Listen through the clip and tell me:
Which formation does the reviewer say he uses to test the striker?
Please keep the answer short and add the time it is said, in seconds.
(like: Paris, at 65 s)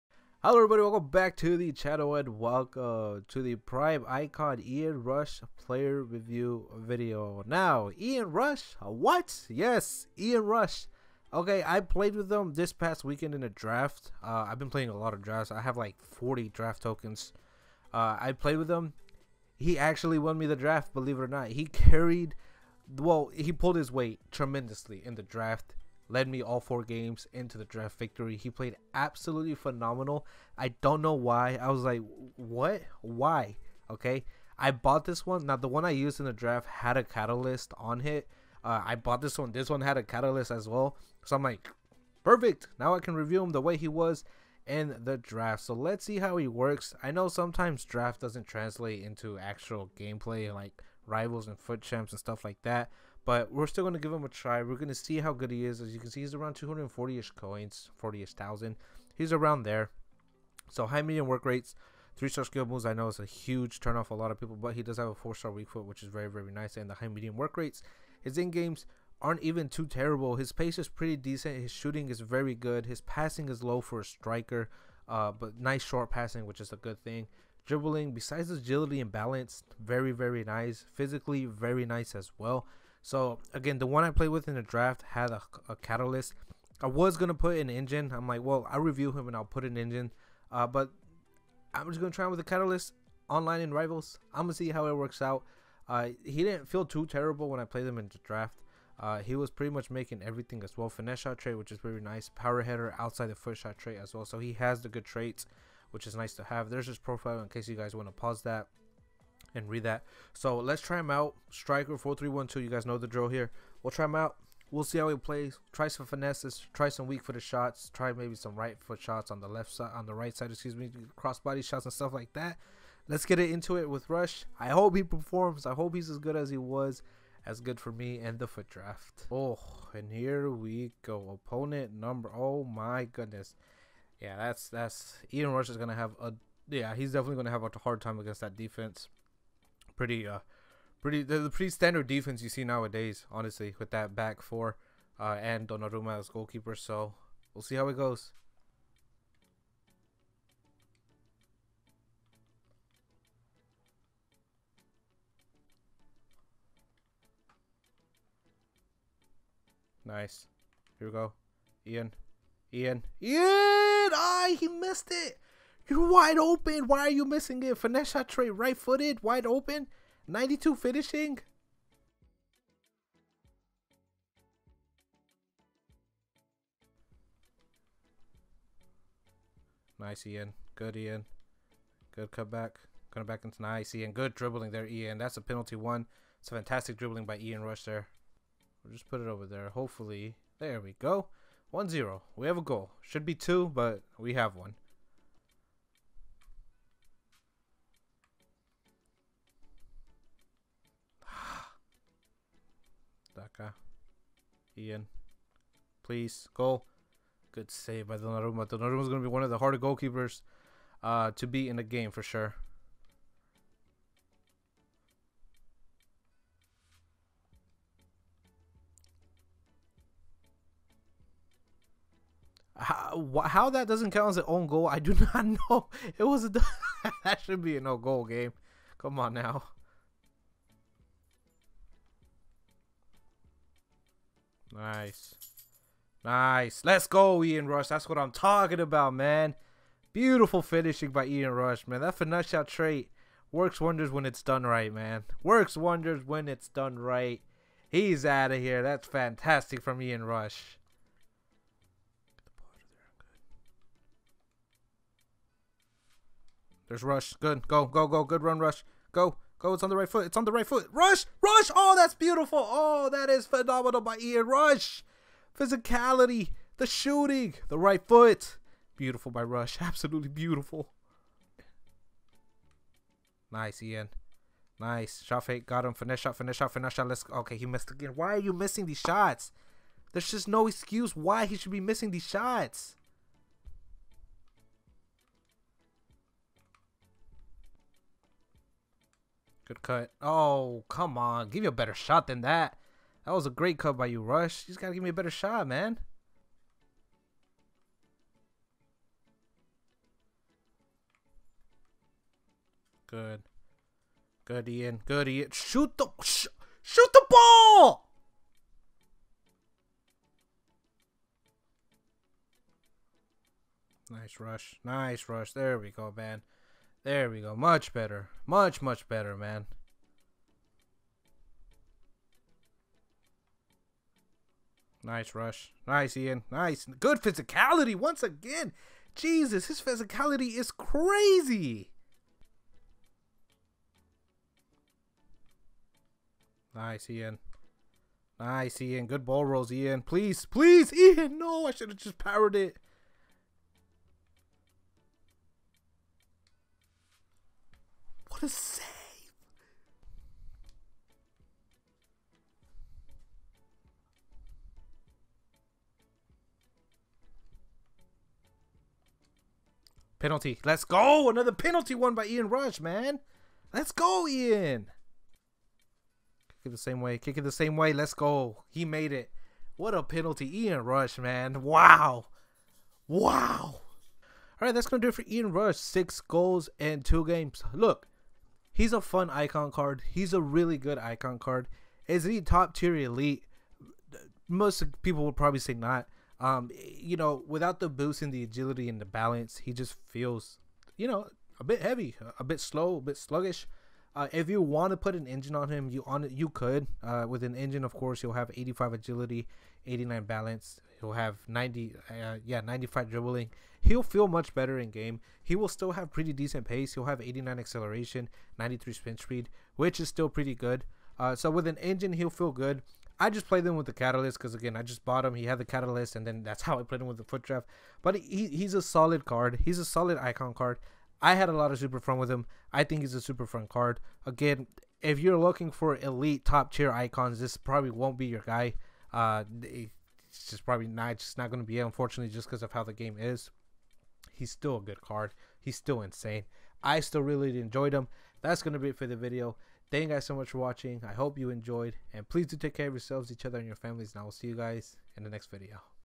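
4312, at 111 s.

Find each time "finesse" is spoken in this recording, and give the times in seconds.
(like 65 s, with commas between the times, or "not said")
100 s, 116 s, 167 s, 242 s.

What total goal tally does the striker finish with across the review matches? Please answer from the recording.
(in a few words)
6 goals.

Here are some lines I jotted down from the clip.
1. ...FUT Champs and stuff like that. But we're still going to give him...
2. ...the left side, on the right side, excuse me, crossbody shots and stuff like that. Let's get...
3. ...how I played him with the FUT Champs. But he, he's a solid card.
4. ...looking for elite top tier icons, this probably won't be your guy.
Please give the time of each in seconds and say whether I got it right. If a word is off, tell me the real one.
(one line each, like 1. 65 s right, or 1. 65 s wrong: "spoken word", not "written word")
1. 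51 s right
2. 119 s right
3. 416 s wrong: "Draft", not "Champs"
4. 425 s right.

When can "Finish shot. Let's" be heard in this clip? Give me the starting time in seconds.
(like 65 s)
276 s.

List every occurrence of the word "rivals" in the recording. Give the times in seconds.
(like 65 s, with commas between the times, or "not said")
51 s, 93 s.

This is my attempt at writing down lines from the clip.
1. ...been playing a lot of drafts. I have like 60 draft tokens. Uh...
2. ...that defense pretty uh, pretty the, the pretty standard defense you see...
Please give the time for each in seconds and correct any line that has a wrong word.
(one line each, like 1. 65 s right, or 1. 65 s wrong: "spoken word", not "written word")
1. 14 s wrong: "40", not "60"
2. 138 s right.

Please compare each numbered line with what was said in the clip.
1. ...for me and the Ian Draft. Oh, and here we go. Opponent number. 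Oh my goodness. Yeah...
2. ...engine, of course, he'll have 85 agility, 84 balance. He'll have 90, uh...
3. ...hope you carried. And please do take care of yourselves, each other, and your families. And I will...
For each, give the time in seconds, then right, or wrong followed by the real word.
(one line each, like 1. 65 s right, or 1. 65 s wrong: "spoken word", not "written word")
1. 127 s wrong: "FUT", not "Ian"
2. 397 s wrong: "89", not "84"
3. 441 s wrong: "enjoyed", not "carried".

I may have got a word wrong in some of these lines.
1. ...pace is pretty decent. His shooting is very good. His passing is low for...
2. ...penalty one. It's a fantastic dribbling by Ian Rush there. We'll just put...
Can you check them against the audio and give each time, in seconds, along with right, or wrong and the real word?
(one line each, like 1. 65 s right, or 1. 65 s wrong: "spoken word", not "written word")
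1. 70 s right
2. 185 s right.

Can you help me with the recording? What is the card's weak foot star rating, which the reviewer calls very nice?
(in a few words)
4.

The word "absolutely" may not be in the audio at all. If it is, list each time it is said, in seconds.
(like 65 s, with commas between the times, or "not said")
28 s, 269 s.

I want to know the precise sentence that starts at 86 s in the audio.
I was gonna put an engine.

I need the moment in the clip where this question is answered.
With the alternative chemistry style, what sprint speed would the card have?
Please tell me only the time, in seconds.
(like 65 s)
408 s.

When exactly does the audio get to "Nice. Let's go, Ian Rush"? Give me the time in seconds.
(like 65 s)
236 s.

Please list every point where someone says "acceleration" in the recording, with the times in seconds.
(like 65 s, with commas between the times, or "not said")
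407 s.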